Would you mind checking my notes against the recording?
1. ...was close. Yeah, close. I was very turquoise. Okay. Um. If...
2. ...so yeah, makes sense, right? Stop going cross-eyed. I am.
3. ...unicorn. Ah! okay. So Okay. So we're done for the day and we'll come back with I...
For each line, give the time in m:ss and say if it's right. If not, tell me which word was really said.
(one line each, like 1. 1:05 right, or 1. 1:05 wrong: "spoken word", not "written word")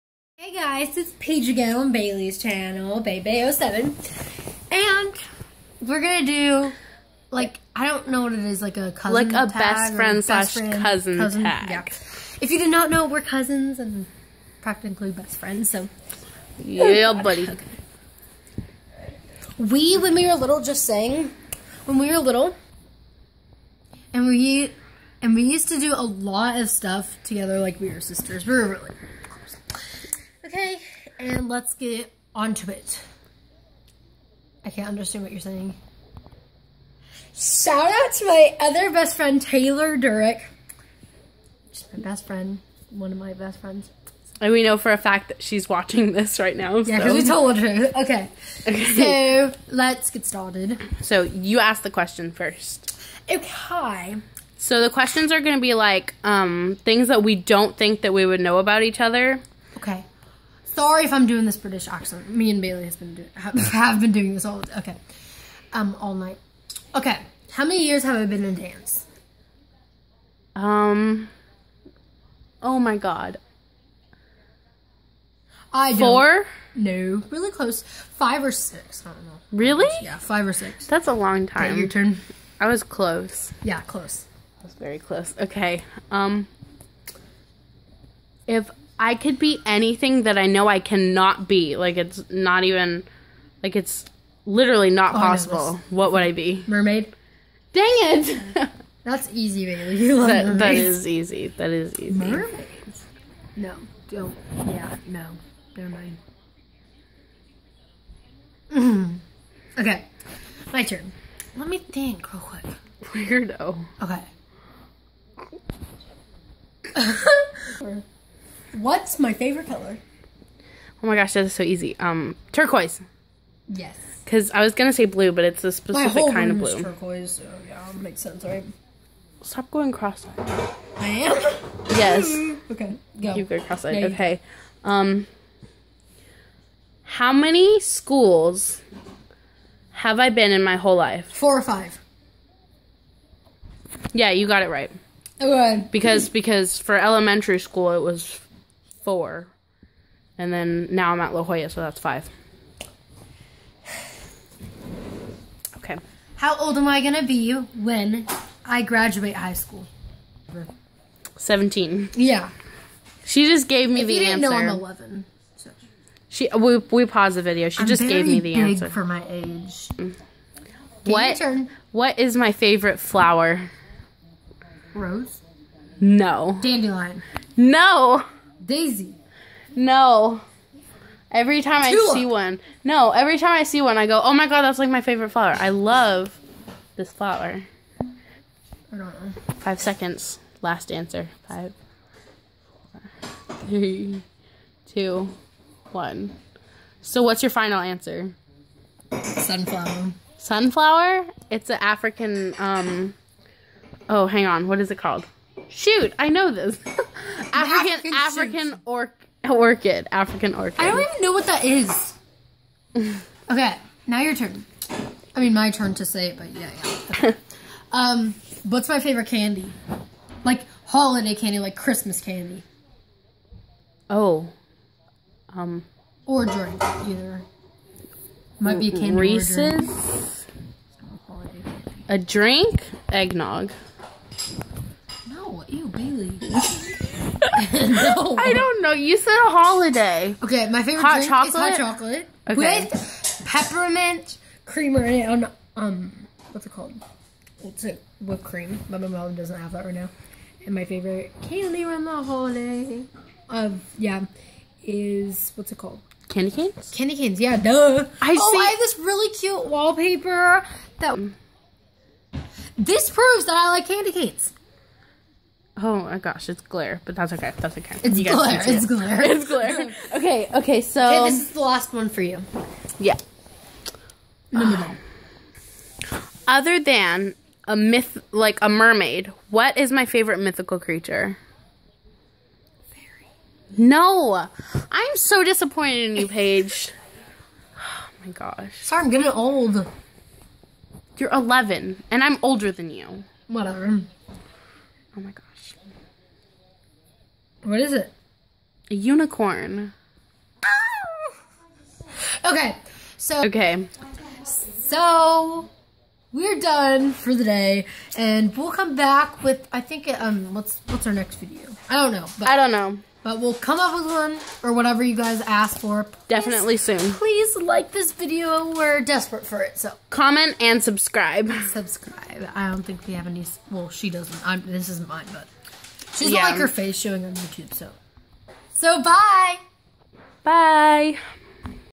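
1. 1:22 wrong: "close", not "turquoise"
2. 2:07 right
3. 4:58 right.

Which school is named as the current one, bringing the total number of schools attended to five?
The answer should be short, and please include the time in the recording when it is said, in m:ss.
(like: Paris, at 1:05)
La Jolla, at 2:31.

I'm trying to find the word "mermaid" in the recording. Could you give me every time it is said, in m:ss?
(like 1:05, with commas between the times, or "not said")
1:36, 1:42, 4:38.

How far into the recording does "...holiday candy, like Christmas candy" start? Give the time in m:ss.
3:40.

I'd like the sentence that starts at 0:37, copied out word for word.
Shout out to my other best friend, Taylor Durick.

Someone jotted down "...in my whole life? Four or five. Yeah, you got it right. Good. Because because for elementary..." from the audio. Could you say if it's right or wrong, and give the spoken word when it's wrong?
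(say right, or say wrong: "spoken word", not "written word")
right.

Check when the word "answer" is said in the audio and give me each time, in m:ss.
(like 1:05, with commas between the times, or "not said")
2:44, 2:48, 3:10, 3:17.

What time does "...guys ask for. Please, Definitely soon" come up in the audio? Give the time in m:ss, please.
5:15.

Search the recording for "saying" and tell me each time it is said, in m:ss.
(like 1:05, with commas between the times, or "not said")
0:20, 0:35.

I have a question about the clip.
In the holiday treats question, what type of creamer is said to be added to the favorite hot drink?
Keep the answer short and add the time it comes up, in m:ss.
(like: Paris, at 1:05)
Peppermint creamer, at 4:03.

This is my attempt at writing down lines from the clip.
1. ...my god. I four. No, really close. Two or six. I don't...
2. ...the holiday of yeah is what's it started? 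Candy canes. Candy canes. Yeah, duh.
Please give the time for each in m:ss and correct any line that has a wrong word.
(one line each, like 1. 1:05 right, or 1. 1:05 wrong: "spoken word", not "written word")
1. 1:12 wrong: "Five", not "Two"
2. 4:12 wrong: "called", not "started".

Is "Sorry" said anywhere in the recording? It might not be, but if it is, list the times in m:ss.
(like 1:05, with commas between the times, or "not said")
1:00, 4:48.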